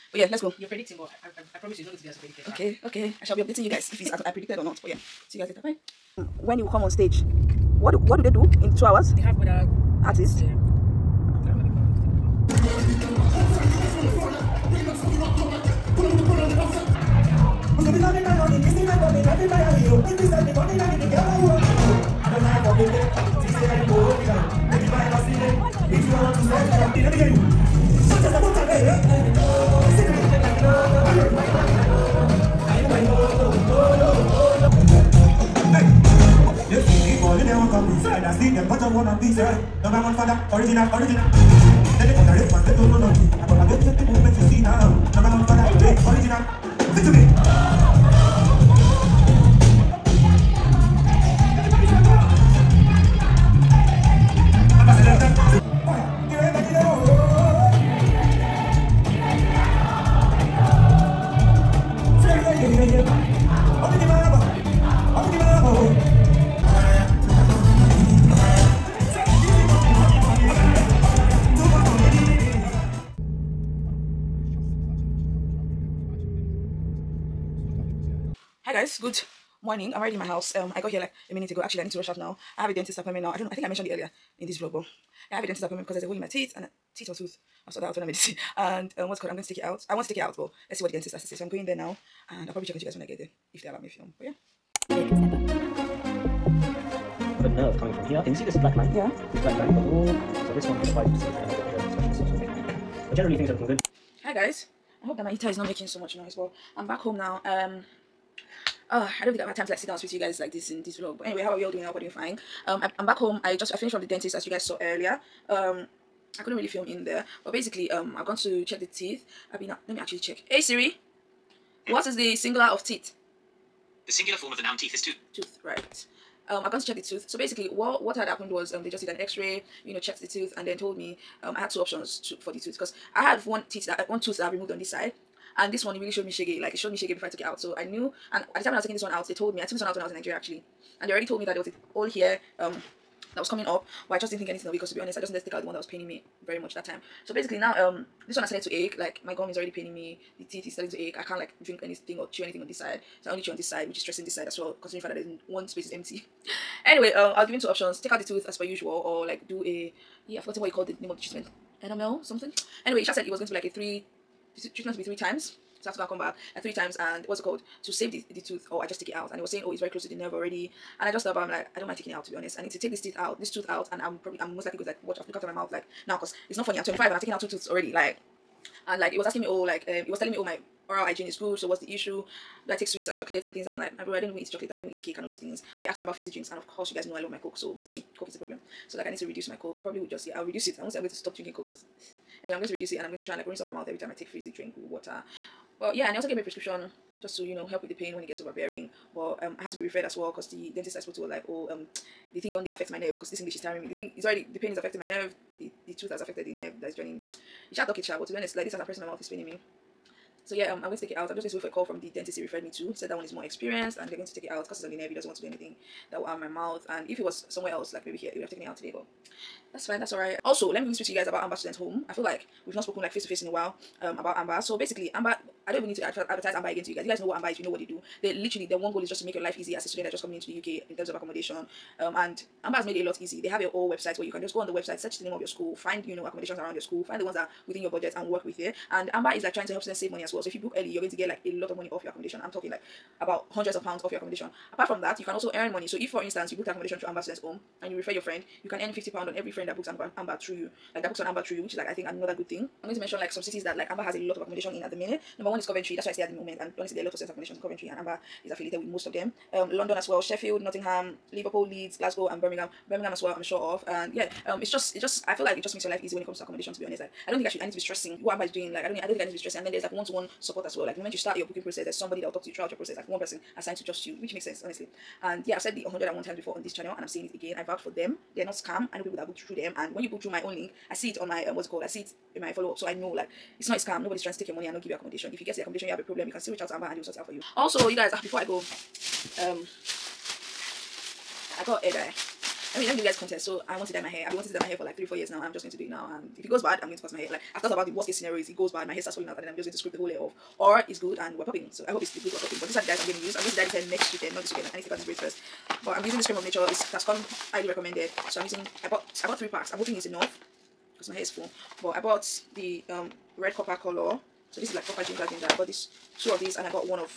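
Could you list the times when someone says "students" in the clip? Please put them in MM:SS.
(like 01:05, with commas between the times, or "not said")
03:41, 03:49, 03:59, 04:07.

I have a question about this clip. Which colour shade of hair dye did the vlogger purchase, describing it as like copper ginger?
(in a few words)
Red copper.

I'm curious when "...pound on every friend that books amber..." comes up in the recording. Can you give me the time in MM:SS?
04:09.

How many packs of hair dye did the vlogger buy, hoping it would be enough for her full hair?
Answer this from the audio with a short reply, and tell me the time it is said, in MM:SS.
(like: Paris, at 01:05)
3, at 05:09.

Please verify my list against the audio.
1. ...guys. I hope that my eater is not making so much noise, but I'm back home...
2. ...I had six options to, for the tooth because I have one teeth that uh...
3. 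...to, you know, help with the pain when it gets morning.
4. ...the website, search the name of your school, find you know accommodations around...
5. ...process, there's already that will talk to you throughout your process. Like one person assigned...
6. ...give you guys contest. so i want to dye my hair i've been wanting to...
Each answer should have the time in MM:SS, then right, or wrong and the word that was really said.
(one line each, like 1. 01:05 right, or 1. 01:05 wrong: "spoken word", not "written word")
1. 01:44 right
2. 02:11 wrong: "two", not "six"
3. 03:17 wrong: "overbearing", not "morning"
4. 03:54 right
5. 04:31 wrong: "somebody", not "already"
6. 04:52 right.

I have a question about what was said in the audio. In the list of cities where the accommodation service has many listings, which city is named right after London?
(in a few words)
Sheffield.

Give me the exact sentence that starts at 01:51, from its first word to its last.
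But anyway, how are we all doing?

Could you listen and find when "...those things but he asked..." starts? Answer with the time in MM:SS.
03:05.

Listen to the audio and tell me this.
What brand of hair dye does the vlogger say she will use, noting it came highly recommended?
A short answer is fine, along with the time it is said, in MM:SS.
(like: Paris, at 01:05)
Cream of Nature, at 05:06.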